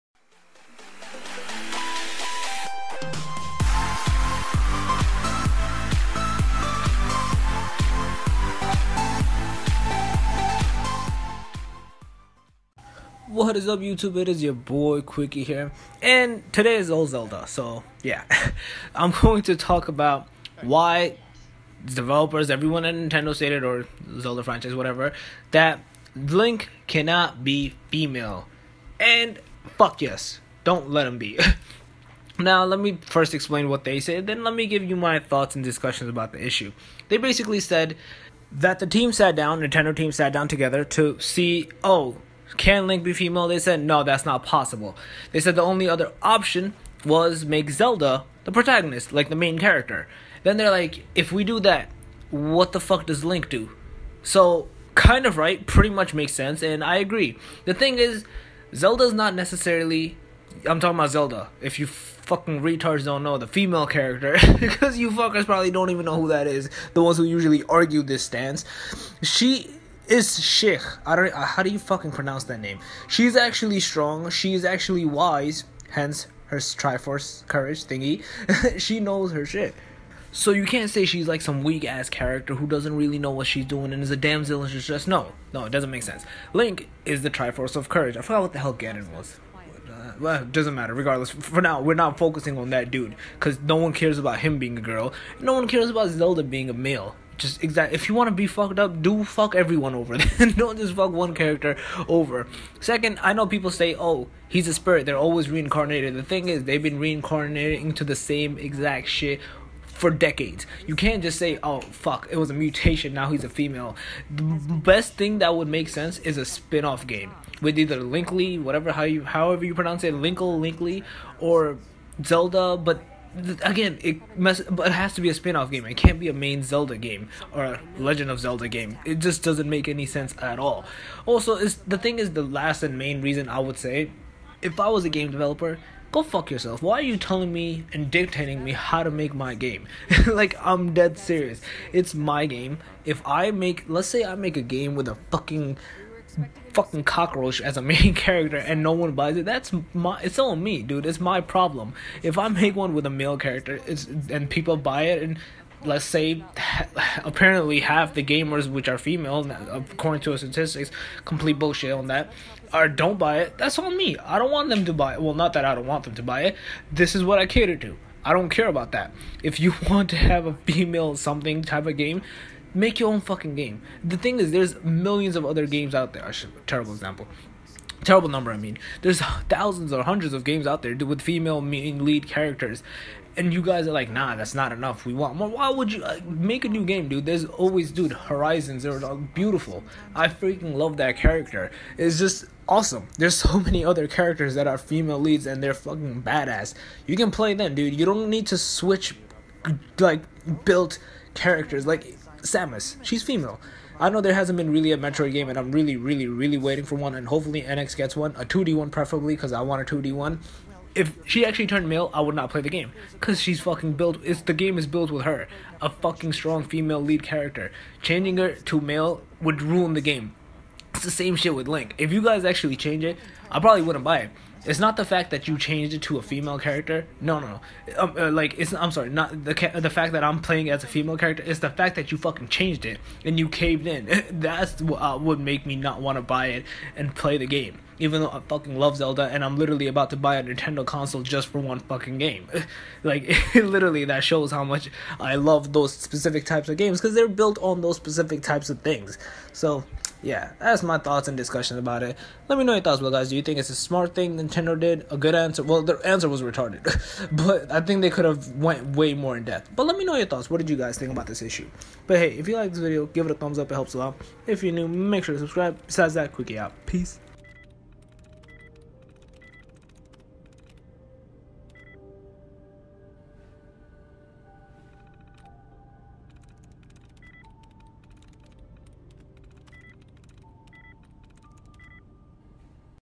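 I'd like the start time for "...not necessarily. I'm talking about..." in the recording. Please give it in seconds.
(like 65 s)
59 s.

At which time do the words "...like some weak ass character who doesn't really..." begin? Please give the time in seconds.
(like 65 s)
81 s.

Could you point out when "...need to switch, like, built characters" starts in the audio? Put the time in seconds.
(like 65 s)
198 s.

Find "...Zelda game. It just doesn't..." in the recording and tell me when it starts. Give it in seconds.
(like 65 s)
128 s.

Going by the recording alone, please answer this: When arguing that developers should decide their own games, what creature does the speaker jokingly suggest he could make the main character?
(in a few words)
cockroach.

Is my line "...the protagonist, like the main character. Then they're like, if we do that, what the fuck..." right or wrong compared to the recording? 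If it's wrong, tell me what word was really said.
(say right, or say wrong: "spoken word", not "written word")
right.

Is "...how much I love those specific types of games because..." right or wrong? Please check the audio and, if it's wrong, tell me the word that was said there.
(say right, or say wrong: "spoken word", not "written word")
right.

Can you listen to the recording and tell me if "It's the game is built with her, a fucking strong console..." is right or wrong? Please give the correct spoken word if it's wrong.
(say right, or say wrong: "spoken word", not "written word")
wrong: "female", not "console".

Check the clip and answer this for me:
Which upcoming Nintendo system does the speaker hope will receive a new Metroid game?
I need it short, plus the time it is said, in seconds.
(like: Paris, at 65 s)
NX, at 207 s.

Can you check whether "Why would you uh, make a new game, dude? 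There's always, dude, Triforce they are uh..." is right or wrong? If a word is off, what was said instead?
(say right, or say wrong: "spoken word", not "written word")
wrong: "Horizons", not "Triforce".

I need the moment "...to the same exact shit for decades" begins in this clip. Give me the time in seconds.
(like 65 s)
107 s.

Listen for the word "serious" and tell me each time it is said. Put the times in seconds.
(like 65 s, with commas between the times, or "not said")
141 s.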